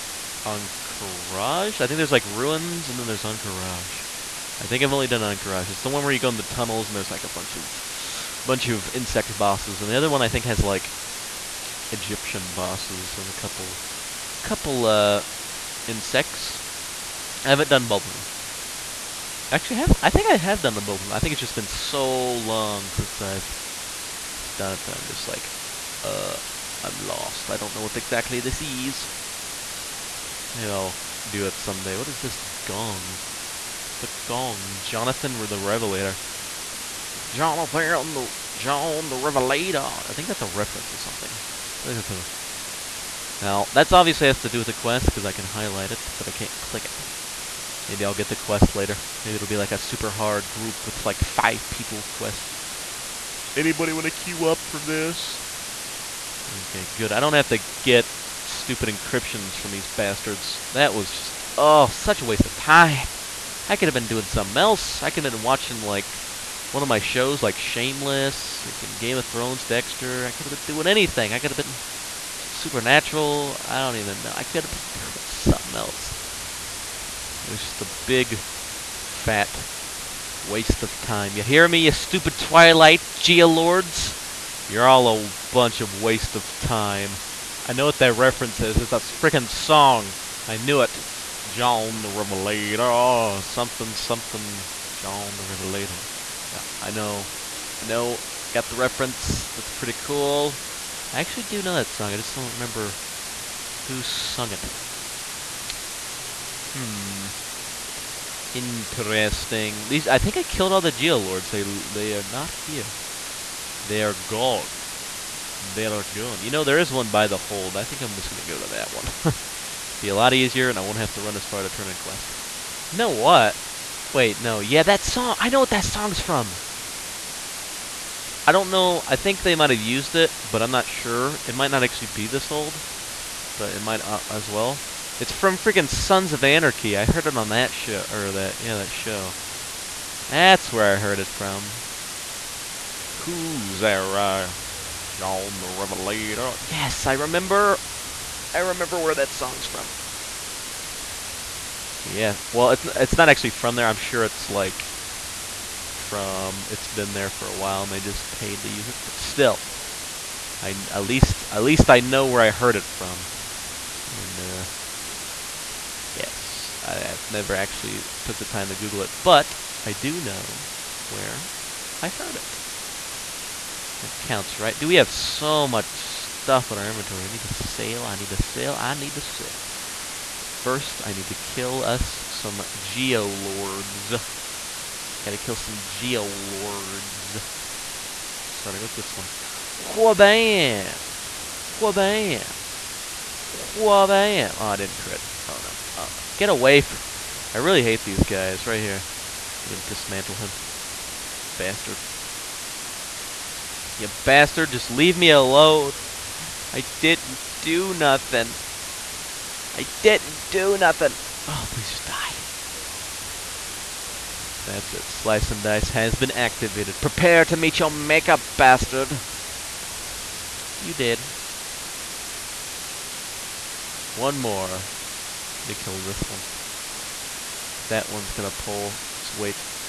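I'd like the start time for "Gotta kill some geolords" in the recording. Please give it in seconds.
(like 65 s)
185 s.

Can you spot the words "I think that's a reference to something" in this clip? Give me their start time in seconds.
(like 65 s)
40 s.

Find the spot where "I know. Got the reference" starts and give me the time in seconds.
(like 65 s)
97 s.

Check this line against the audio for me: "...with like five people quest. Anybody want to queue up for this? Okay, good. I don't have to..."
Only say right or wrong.
right.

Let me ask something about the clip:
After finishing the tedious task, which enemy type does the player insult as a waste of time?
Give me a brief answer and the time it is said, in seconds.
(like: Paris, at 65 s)
Twilight geolords, at 82 s.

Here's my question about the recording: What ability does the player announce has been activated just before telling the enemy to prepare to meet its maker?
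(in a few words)
Slice and Dice.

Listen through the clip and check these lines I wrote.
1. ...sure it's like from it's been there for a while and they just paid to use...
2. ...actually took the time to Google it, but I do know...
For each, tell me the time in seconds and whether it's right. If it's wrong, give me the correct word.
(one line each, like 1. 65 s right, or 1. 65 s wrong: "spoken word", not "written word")
1. 153 s right
2. 167 s right.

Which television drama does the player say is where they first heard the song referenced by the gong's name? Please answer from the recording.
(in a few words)
Sons of Anarchy.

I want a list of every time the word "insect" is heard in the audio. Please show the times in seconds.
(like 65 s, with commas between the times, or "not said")
8 s, 15 s.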